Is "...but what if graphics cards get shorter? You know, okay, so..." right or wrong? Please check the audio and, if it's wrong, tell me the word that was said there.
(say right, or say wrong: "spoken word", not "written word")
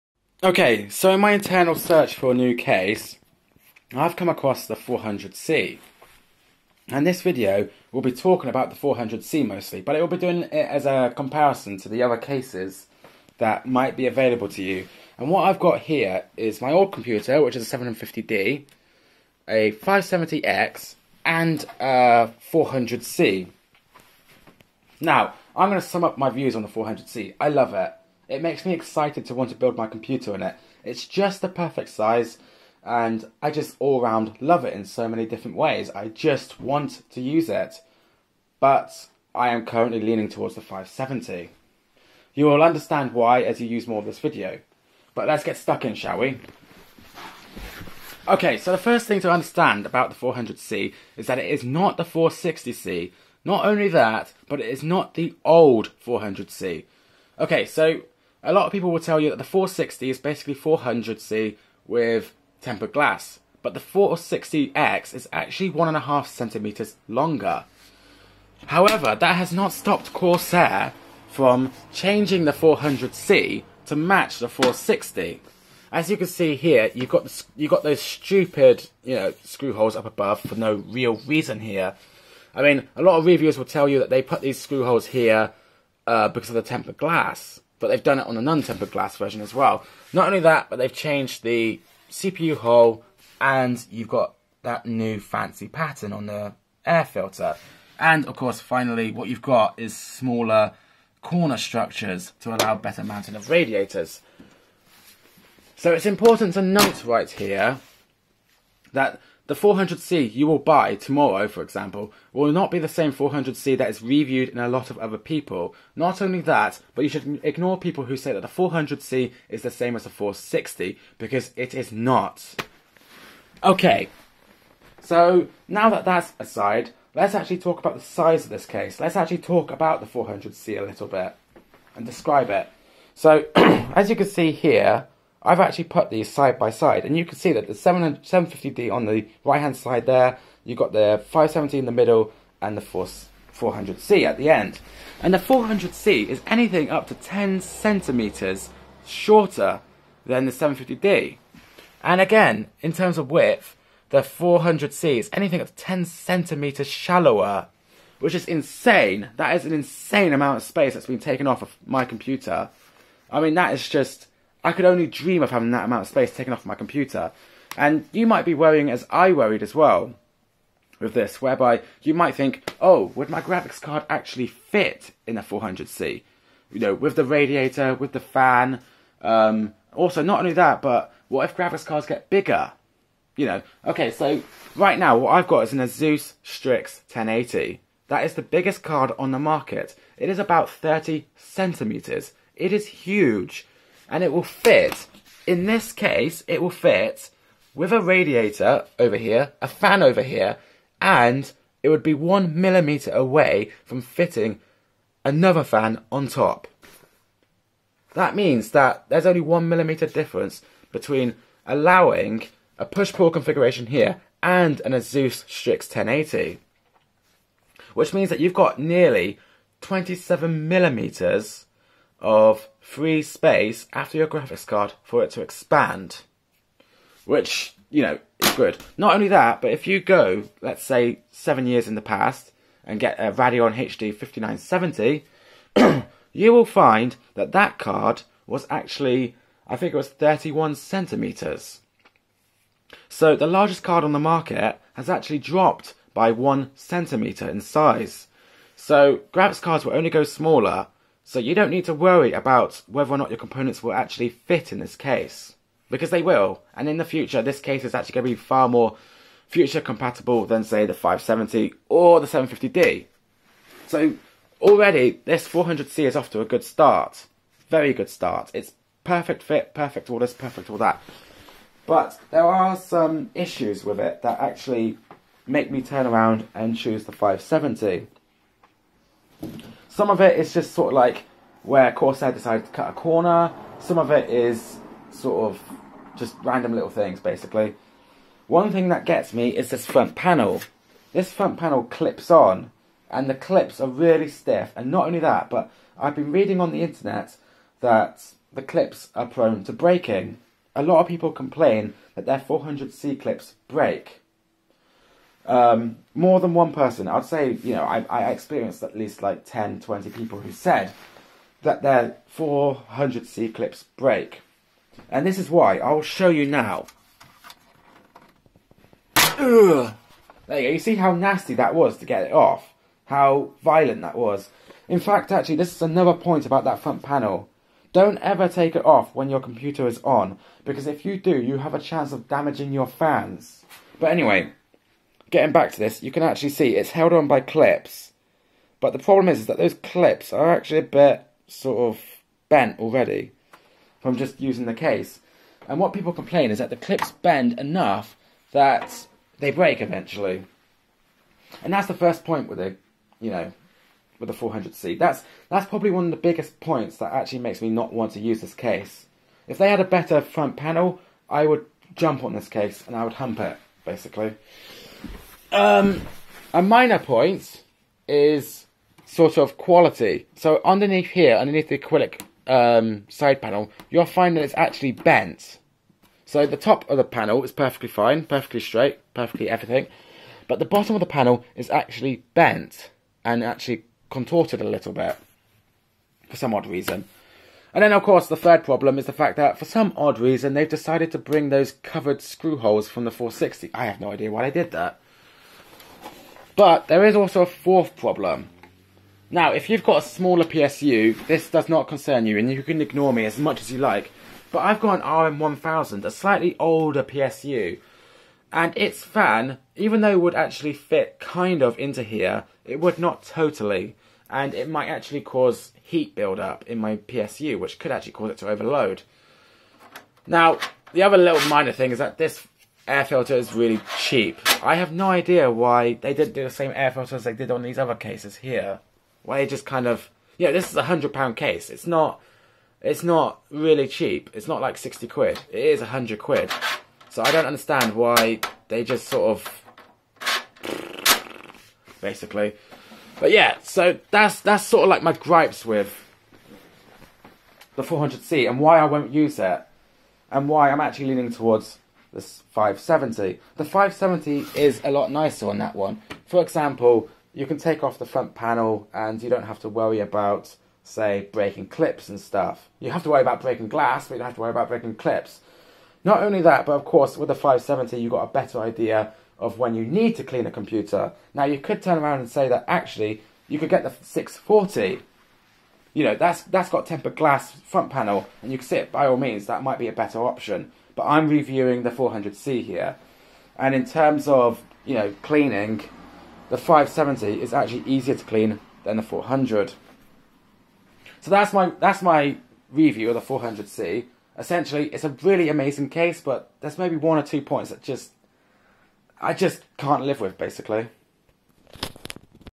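wrong: "bigger", not "shorter".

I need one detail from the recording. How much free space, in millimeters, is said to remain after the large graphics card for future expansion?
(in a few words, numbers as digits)
27 millimeters.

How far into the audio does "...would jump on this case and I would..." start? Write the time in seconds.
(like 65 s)
361 s.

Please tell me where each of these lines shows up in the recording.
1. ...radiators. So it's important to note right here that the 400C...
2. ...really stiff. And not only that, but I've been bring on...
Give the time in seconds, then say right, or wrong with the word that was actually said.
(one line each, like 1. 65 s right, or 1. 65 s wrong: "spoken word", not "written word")
1. 103 s right
2. 293 s wrong: "reading", not "bring".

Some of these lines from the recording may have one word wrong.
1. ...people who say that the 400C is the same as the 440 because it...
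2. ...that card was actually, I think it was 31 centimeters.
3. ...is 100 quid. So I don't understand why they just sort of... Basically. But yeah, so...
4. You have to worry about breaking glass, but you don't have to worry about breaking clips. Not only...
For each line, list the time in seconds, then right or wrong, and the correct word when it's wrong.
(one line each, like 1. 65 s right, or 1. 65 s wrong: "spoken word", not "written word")
1. 117 s wrong: "460", not "440"
2. 237 s right
3. 435 s right
4. 462 s right.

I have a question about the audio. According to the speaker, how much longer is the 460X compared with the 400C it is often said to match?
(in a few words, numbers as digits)
1.5 centimeters.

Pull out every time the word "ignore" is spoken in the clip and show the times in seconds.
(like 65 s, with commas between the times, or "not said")
117 s, 402 s.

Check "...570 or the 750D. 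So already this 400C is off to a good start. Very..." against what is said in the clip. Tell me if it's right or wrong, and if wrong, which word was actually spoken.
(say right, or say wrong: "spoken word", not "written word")
right.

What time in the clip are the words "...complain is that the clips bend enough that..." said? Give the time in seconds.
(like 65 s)
346 s.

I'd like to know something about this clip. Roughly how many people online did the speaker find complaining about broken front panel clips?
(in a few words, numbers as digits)
10 to 20.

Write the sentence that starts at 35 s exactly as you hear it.
I just want to use it, but I am currently leaning towards the 570.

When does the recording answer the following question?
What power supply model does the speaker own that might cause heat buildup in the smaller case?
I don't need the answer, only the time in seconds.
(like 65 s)
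405 s.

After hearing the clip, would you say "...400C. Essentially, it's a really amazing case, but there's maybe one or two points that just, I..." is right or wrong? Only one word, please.
right.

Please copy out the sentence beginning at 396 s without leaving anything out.
But there is also a fourth problem.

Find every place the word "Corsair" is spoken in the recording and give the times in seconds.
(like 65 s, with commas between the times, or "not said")
70 s, 281 s.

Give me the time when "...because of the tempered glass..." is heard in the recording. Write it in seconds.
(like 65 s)
86 s.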